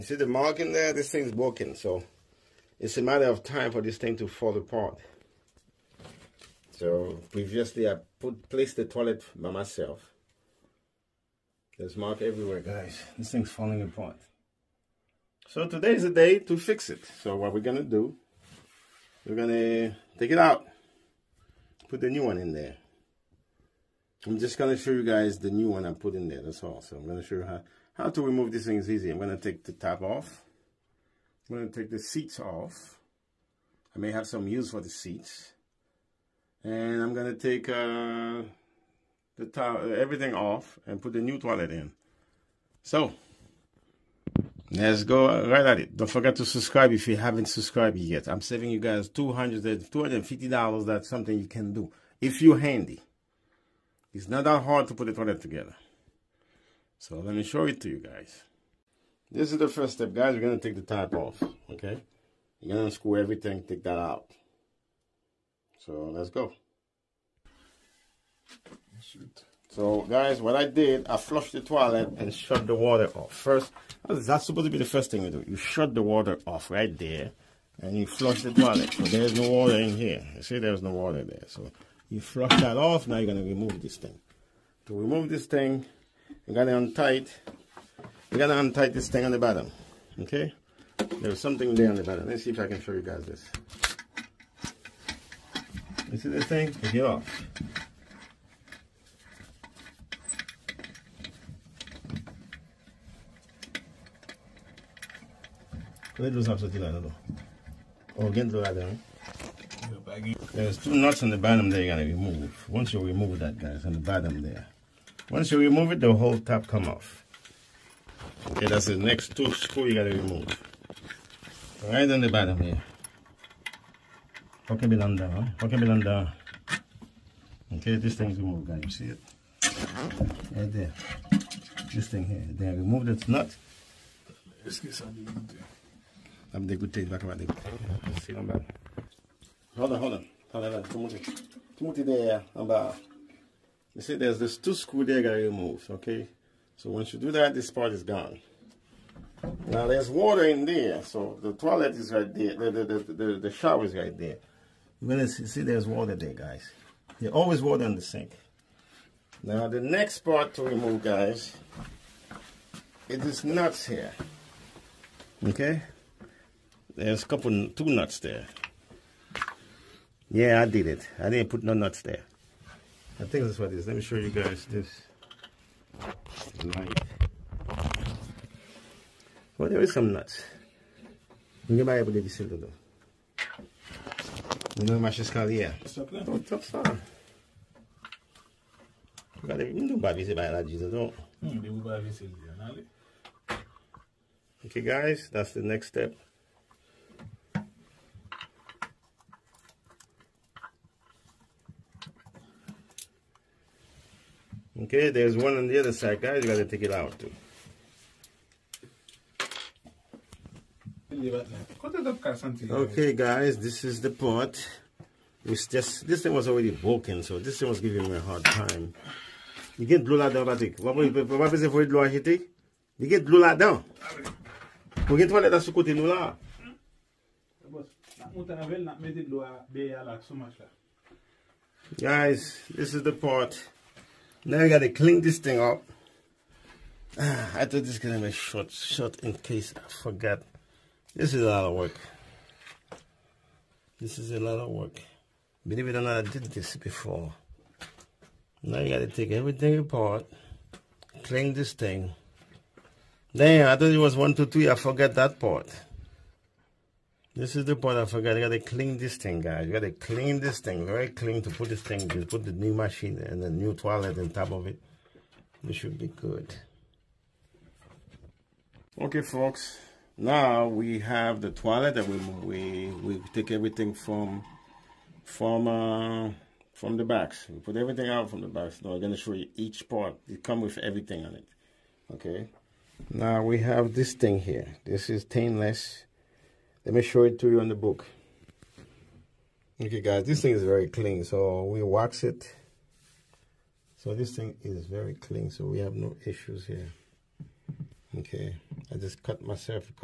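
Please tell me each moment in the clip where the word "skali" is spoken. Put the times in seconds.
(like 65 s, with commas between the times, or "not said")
185 s.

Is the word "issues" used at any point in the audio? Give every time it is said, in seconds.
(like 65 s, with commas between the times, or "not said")
296 s.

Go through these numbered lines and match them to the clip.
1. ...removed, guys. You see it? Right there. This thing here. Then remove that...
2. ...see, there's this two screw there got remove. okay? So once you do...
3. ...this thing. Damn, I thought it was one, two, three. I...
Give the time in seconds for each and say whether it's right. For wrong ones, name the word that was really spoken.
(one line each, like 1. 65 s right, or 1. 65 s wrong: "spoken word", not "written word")
1. 128 s right
2. 144 s right
3. 251 s right.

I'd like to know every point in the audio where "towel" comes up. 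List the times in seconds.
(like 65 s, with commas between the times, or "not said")
39 s.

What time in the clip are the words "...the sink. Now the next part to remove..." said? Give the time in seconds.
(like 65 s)
157 s.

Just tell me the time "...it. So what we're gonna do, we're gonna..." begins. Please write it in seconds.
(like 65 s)
16 s.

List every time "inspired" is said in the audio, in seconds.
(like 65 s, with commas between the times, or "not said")
not said.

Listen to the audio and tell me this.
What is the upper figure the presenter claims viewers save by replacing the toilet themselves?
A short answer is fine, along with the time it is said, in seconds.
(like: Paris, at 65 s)
$250, at 49 s.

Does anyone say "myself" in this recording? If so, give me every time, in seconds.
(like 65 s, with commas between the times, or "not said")
9 s, 299 s.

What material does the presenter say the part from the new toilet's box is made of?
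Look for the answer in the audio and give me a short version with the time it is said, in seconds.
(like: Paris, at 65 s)
stainless, at 285 s.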